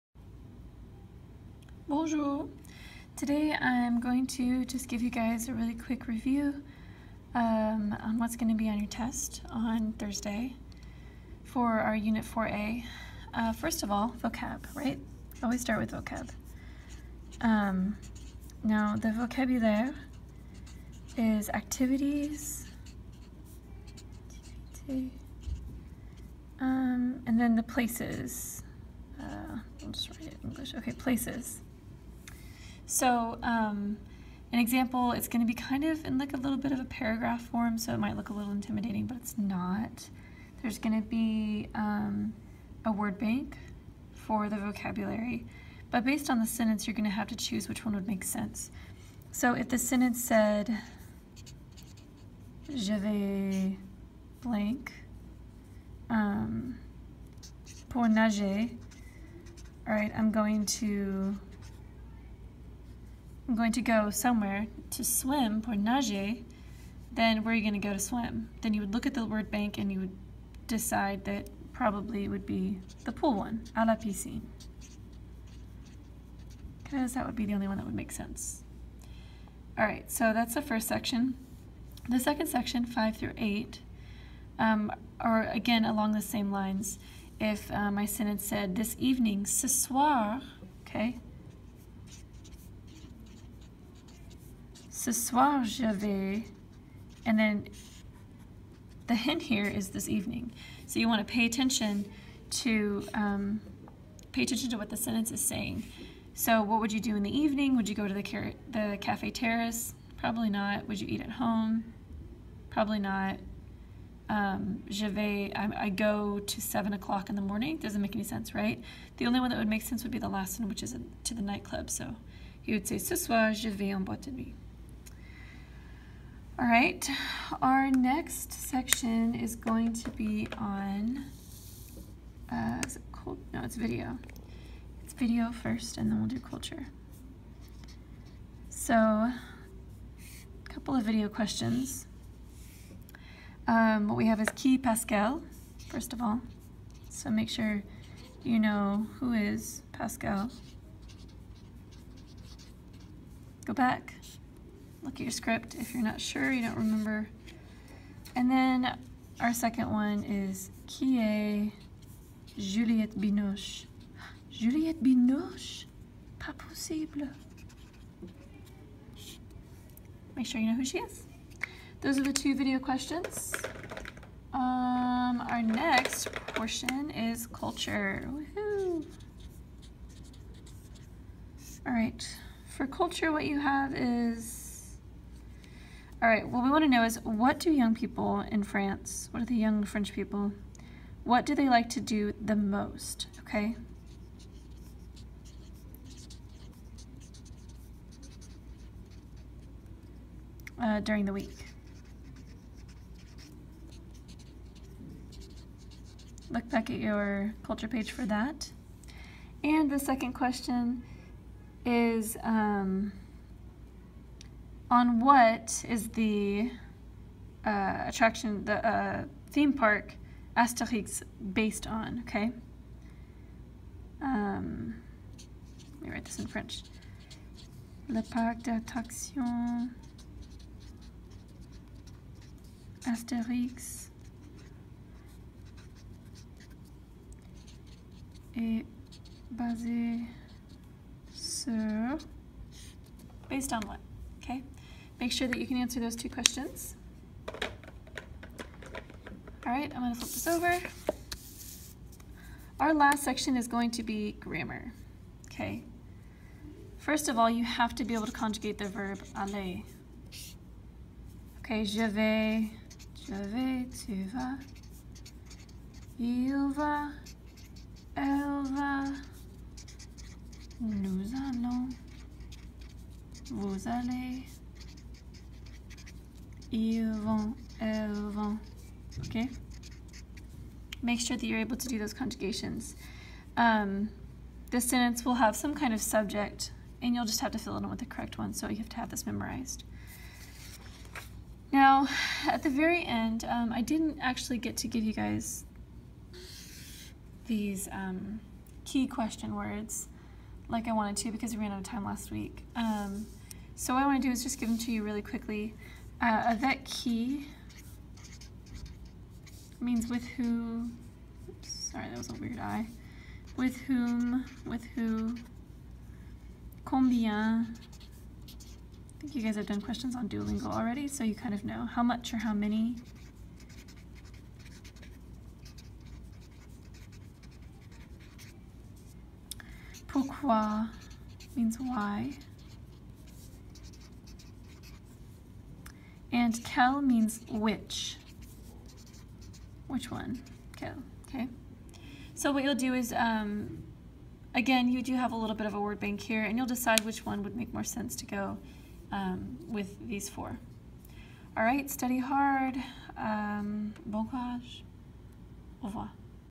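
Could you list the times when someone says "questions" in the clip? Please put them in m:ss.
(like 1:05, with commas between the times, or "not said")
2:21, 2:52, 3:30, 4:06, 4:59, 5:19.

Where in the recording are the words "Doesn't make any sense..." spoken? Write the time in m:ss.
1:57.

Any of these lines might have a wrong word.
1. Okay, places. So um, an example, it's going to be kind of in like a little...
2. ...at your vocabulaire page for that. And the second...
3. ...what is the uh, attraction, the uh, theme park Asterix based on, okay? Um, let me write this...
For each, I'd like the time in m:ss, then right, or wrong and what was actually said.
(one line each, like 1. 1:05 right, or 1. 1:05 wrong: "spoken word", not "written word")
1. 0:30 right
2. 3:26 wrong: "culture", not "vocabulaire"
3. 3:35 right.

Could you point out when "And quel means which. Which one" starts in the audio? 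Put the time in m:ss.
5:36.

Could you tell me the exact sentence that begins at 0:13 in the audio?
Uh, first of all, vocab, right?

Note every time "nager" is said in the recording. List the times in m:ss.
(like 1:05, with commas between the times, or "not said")
0:58, 1:05.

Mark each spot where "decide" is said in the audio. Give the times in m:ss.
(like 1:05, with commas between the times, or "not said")
1:10, 5:46.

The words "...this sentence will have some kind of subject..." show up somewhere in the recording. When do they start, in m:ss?
4:44.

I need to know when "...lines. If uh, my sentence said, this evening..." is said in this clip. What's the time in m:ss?
1:26.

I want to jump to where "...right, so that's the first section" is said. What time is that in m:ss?
1:19.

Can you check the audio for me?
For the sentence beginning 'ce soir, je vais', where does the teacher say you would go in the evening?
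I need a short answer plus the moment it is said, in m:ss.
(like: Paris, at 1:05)
en boîte de nuit, at 2:03.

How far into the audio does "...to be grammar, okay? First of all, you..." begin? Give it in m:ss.
4:13.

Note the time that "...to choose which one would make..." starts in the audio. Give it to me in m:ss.
0:47.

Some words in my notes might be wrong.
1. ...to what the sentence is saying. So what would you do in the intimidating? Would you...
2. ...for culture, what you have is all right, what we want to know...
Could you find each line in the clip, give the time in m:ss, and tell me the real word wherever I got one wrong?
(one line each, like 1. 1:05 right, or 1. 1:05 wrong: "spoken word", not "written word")
1. 1:44 wrong: "evening", not "intimidating"
2. 3:02 right.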